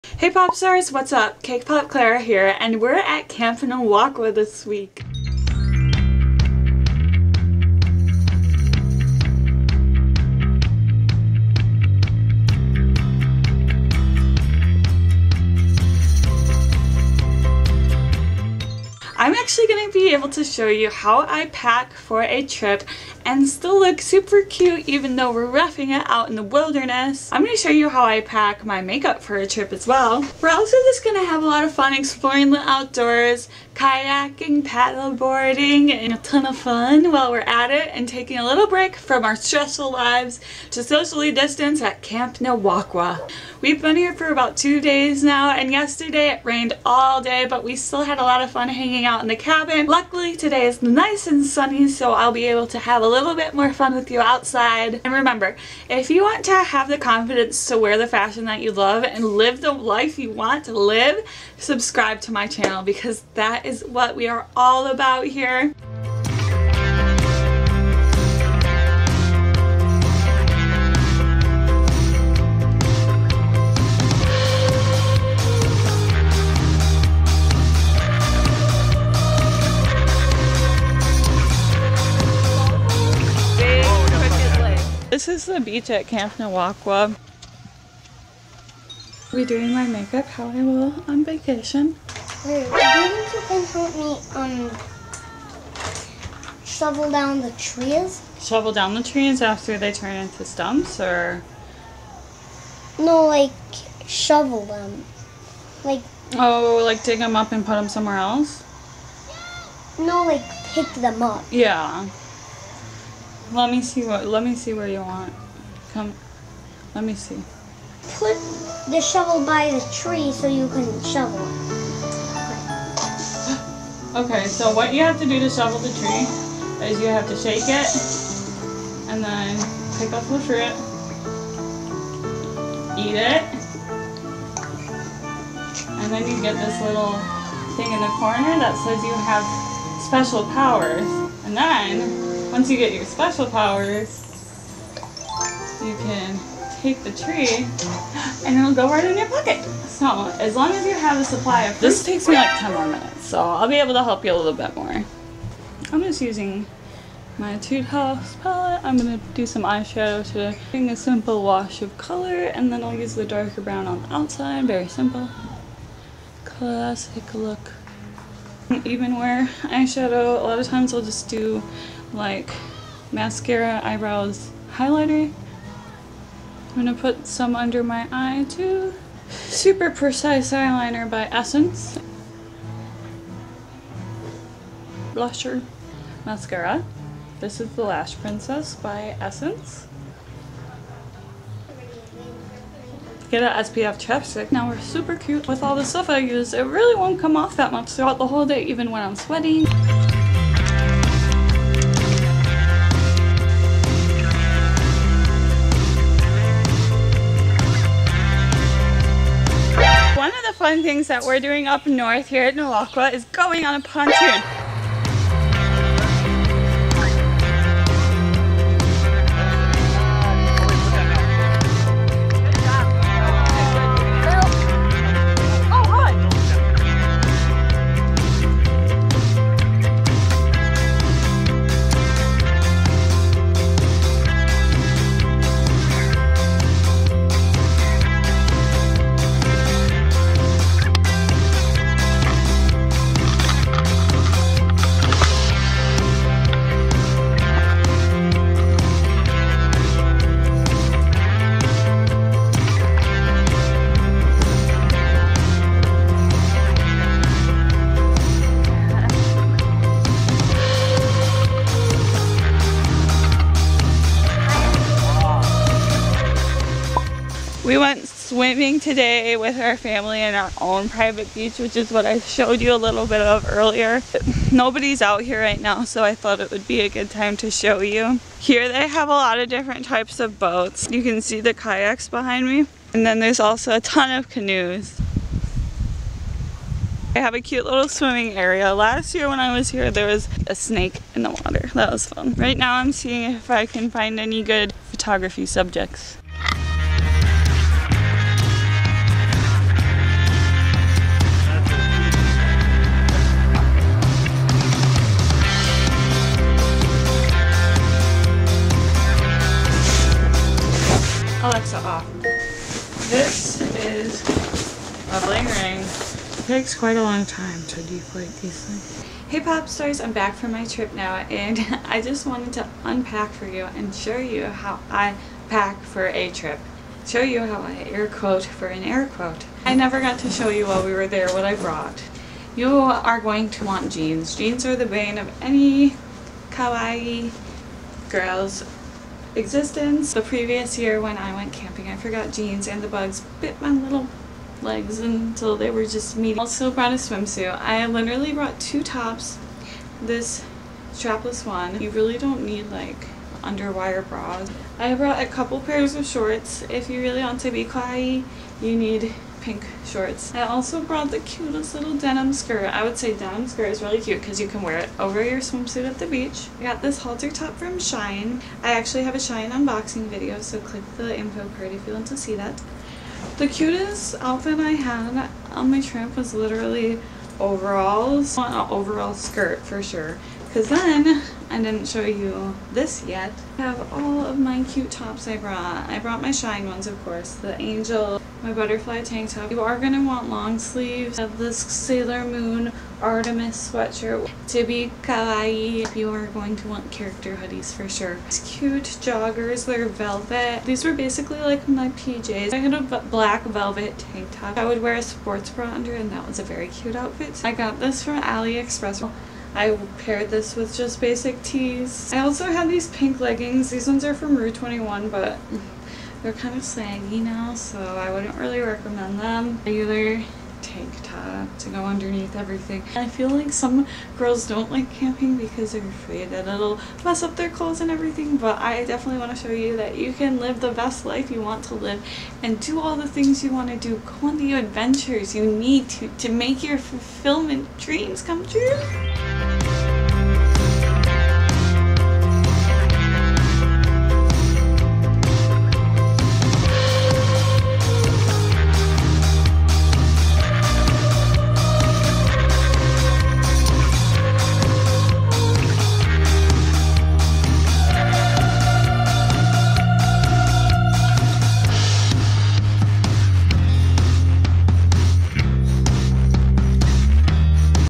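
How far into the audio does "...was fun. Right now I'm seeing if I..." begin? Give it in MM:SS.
04:51.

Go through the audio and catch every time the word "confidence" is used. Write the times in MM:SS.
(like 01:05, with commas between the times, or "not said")
00:56.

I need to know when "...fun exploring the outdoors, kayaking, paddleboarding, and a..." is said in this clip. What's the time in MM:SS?
00:31.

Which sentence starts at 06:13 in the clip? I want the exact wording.
The cutest outfit I had on my trip was literally overalls.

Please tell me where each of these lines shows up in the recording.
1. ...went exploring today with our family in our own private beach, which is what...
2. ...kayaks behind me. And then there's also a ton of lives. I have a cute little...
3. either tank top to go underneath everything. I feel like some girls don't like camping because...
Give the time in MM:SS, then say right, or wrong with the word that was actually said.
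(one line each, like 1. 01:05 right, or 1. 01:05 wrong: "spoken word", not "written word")
1. 04:27 wrong: "swimming", not "exploring"
2. 04:41 wrong: "canoes", not "lives"
3. 06:59 right.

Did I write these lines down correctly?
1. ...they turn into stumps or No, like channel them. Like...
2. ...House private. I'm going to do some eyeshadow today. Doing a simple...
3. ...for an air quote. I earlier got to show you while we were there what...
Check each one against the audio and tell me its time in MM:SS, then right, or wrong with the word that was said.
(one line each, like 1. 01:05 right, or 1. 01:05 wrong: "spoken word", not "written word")
1. 01:39 wrong: "shovel", not "channel"
2. 02:37 wrong: "palette", not "private"
3. 05:28 wrong: "never", not "earlier".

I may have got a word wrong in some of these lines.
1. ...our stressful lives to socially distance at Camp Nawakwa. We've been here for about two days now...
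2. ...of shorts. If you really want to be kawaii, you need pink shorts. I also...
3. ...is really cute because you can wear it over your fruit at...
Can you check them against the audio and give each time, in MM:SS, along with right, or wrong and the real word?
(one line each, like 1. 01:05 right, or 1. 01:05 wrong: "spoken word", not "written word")
1. 00:39 right
2. 05:55 right
3. 06:03 wrong: "swimsuit", not "fruit".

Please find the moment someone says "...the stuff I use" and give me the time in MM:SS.
03:15.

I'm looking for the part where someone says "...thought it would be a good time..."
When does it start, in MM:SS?
04:36.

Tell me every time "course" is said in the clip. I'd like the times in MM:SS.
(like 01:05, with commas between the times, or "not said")
06:27.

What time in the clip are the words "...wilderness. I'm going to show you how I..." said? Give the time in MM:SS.
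00:26.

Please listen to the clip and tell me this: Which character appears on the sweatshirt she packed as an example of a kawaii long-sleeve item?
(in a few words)
Sailor Moon Artemis.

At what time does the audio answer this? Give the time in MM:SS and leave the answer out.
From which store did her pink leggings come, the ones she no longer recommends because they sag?
06:54.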